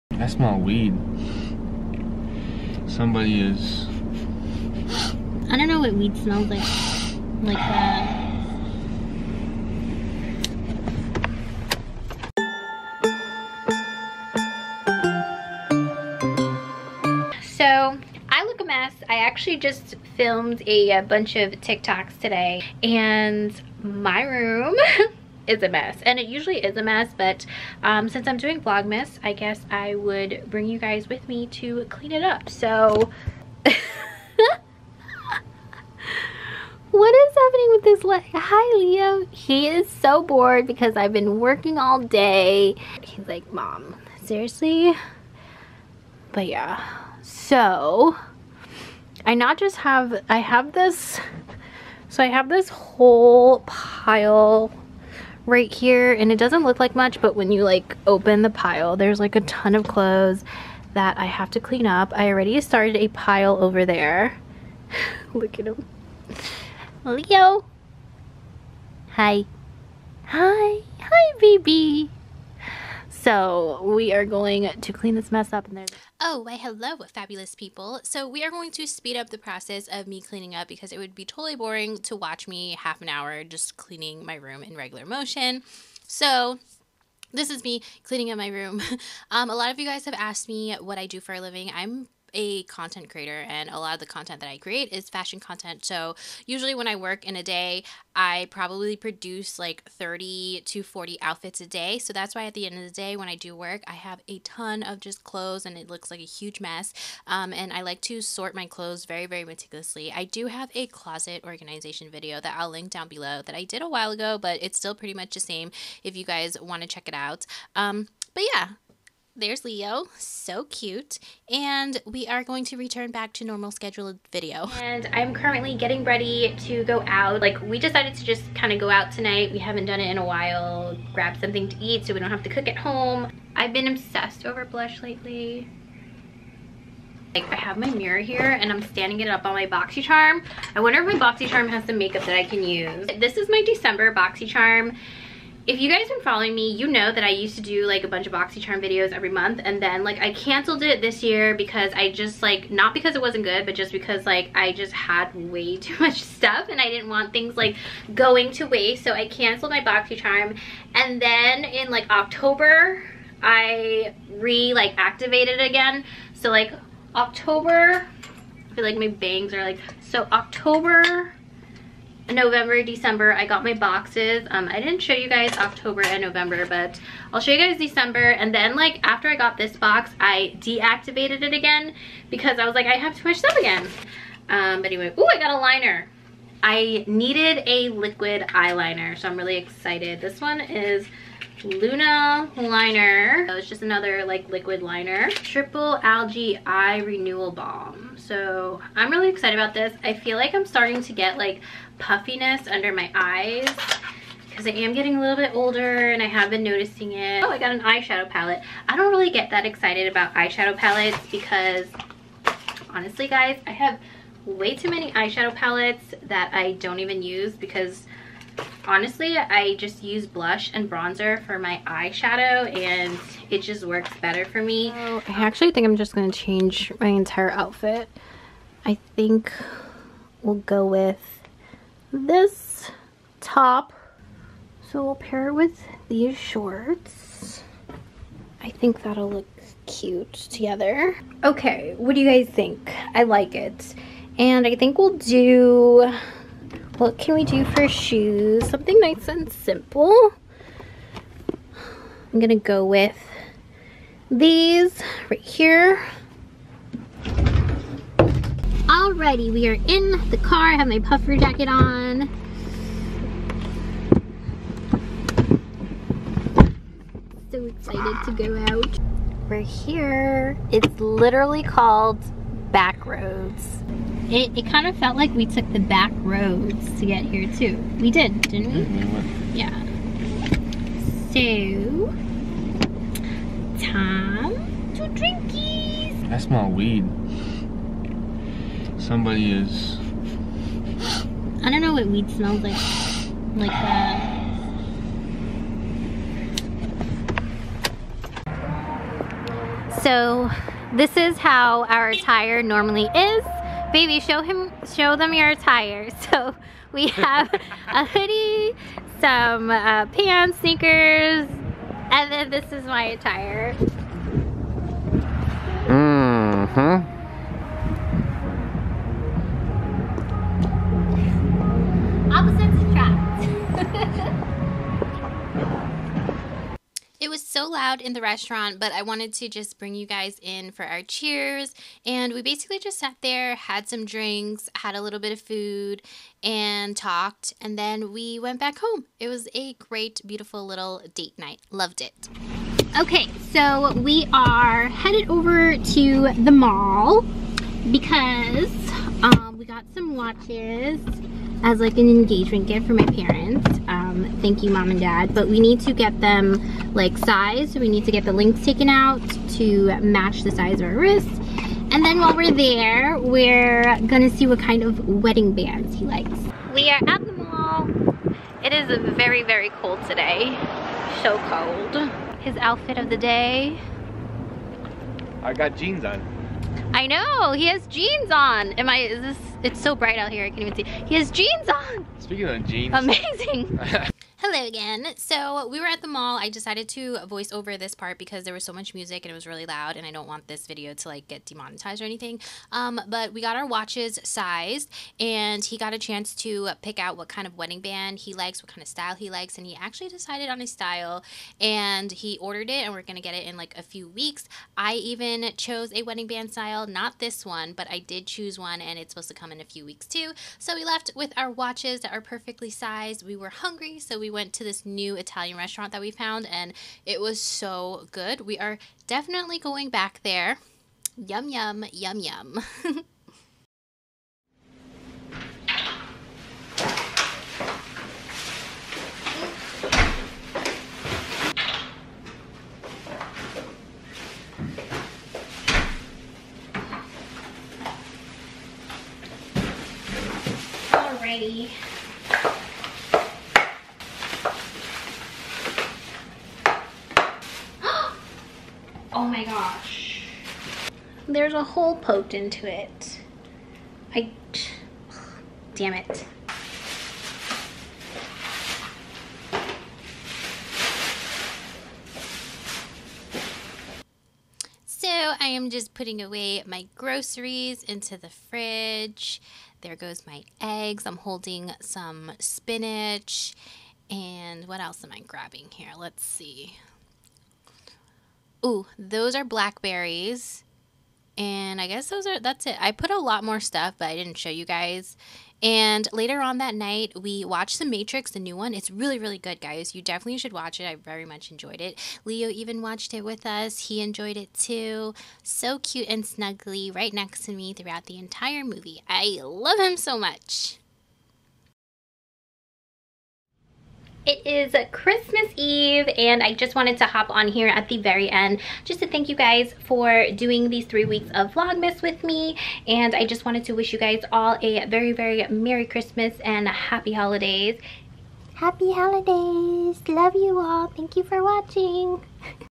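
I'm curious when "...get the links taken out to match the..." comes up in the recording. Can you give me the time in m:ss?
5:58.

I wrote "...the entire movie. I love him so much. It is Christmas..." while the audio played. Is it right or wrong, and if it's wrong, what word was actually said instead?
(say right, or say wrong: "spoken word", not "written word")
right.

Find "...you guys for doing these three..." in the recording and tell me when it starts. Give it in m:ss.
8:29.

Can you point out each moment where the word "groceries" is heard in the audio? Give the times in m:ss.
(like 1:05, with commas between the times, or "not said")
7:46.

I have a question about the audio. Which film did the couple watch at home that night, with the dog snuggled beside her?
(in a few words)
The Matrix.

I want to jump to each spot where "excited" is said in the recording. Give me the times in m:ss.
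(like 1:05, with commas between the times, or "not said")
3:09, 3:19, 3:29, 4:27.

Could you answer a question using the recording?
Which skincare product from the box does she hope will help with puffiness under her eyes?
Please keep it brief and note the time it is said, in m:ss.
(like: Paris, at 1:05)
Triple Algae Eye Renewal Balm, at 3:15.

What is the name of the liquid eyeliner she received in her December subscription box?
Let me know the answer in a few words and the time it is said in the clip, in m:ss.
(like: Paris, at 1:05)
Luna Liner, at 3:11.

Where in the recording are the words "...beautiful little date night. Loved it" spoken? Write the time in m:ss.
5:40.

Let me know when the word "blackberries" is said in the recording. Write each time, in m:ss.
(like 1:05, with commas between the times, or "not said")
7:59.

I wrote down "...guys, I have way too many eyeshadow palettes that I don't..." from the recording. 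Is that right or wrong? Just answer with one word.
right.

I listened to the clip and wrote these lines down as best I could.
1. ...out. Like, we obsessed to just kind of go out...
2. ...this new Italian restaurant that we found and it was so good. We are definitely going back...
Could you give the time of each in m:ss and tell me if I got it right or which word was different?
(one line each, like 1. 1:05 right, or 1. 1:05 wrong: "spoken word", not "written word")
1. 2:07 wrong: "decided", not "obsessed"
2. 6:54 right.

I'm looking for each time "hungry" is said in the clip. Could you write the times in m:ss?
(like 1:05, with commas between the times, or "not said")
6:53.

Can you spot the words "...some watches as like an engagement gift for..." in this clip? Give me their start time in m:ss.
5:49.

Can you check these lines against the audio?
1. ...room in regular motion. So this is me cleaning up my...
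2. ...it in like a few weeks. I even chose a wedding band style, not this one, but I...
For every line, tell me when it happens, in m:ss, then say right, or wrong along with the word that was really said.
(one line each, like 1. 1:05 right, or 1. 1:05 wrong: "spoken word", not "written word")
1. 1:24 right
2. 6:43 right.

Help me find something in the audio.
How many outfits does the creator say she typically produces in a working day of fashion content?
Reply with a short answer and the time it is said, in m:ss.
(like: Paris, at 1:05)
30 to 40, at 1:39.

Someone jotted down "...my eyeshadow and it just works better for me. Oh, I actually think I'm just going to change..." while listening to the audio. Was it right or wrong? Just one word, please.
right.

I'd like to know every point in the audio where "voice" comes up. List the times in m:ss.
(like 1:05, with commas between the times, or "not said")
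6:27.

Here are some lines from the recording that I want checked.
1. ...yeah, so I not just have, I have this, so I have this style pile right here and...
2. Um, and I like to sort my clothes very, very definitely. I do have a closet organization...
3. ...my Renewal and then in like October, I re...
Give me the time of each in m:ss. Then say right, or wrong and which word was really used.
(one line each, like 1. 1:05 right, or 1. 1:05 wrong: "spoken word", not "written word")
1. 0:46 wrong: "whole", not "style"
2. 1:47 wrong: "meticulously", not "definitely"
3. 2:39 wrong: "BoxyCharm", not "Renewal".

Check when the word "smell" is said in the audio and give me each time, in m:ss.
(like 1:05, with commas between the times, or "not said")
0:00, 0:06, 4:46, 4:52.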